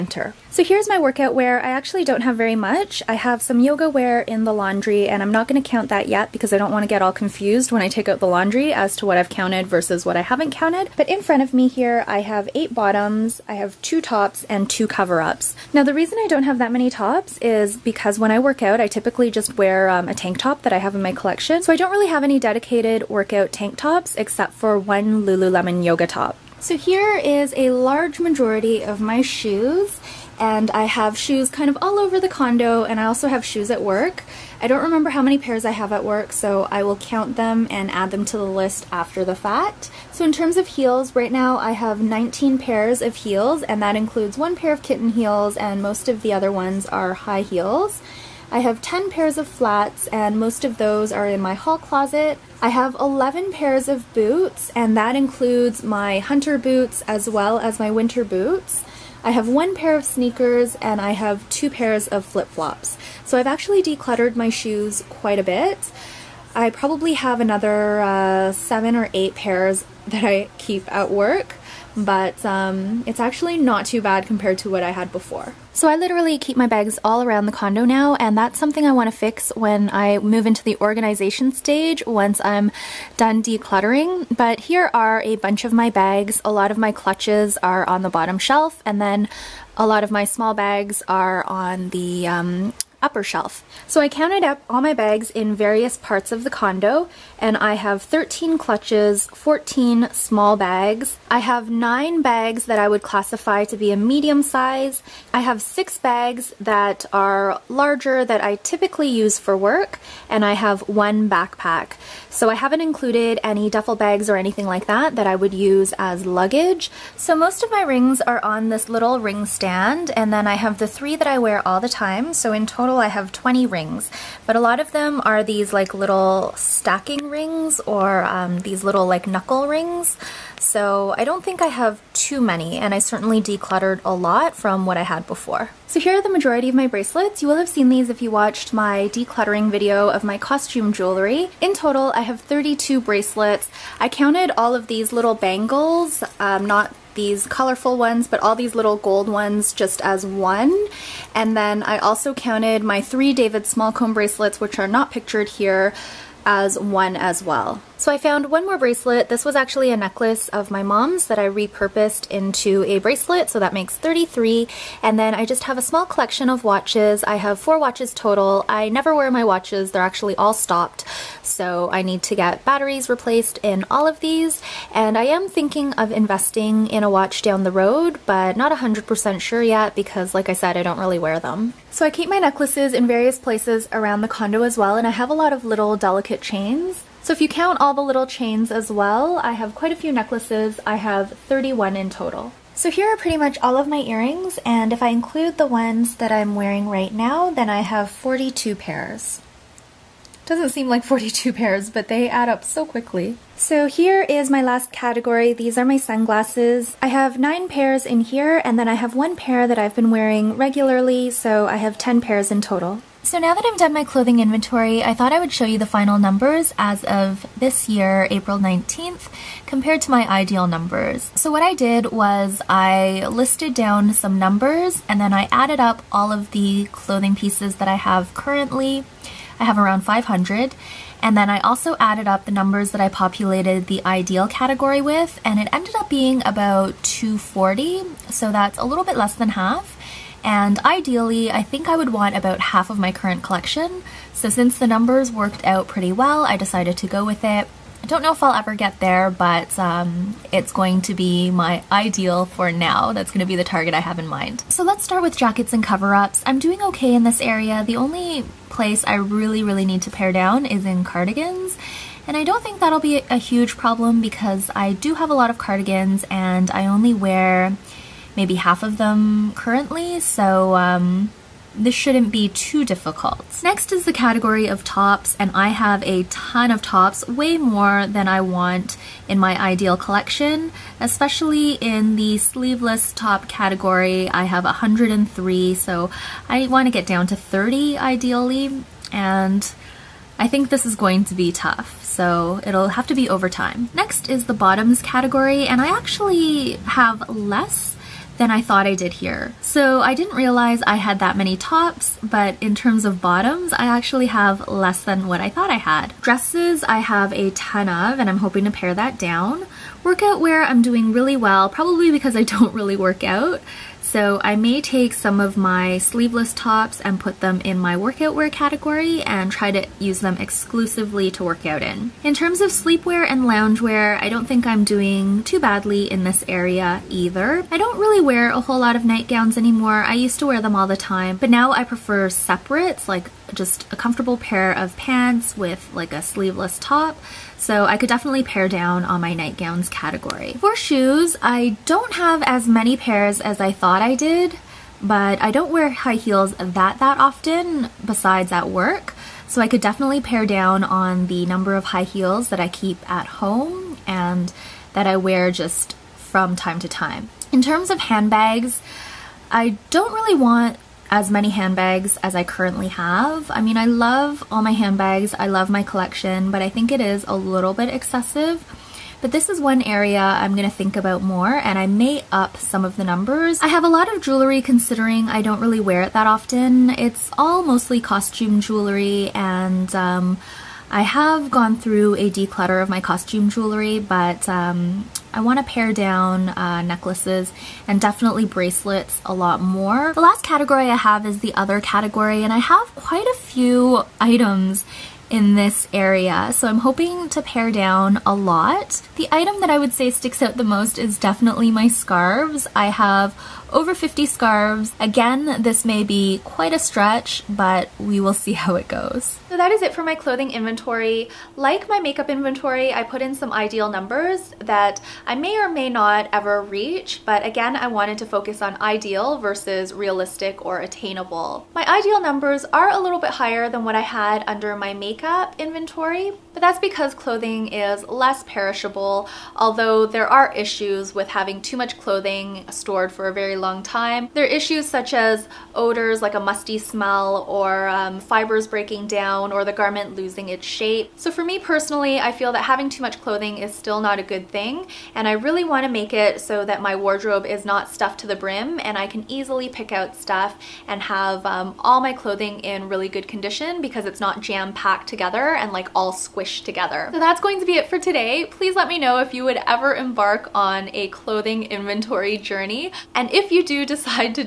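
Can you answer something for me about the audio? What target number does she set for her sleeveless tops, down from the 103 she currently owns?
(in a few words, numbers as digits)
30.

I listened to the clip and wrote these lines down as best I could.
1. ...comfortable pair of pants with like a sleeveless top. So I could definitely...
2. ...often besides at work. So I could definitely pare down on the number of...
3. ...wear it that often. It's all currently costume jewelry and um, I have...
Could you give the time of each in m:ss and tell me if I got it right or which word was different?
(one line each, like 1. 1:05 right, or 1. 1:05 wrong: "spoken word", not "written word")
1. 5:33 right
2. 5:47 right
3. 6:15 wrong: "mostly", not "currently".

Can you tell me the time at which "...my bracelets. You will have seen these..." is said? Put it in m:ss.
2:16.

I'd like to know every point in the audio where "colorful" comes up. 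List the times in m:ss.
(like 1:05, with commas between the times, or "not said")
2:27.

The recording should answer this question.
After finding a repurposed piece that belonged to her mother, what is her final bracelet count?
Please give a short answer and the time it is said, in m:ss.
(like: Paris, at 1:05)
33, at 2:43.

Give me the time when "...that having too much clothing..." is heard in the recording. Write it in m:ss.
7:22.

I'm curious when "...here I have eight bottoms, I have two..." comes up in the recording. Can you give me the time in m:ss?
0:11.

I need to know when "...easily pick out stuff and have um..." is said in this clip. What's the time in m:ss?
7:29.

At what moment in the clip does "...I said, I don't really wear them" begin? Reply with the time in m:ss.
3:00.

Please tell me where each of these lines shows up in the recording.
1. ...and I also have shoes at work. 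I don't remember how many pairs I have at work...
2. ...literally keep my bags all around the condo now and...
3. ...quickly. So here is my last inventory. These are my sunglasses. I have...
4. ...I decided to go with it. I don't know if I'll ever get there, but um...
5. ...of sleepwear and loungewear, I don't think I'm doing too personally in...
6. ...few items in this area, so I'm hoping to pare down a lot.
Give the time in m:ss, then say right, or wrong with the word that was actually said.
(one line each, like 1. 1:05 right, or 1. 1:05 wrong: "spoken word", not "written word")
1. 0:32 right
2. 1:15 right
3. 3:22 wrong: "category", not "inventory"
4. 4:06 right
5. 5:22 wrong: "badly", not "personally"
6. 6:33 right.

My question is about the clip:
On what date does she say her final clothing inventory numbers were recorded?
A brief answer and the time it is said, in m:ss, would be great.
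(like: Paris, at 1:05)
April 19th, at 3:38.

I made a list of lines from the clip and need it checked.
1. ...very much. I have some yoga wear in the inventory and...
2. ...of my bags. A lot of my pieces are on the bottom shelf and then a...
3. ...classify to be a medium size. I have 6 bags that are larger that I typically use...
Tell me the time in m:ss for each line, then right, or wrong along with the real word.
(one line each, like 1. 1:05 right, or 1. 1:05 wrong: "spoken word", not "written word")
1. 0:02 wrong: "laundry", not "inventory"
2. 1:25 wrong: "clutches", not "pieces"
3. 1:43 right.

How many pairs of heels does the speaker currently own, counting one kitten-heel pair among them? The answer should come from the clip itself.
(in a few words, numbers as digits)
19.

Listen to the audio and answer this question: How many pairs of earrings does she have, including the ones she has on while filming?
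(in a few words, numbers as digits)
42.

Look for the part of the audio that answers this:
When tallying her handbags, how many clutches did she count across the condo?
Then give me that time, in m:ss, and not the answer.
1:38.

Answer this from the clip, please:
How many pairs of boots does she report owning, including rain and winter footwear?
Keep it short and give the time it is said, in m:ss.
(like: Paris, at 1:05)
11, at 0:52.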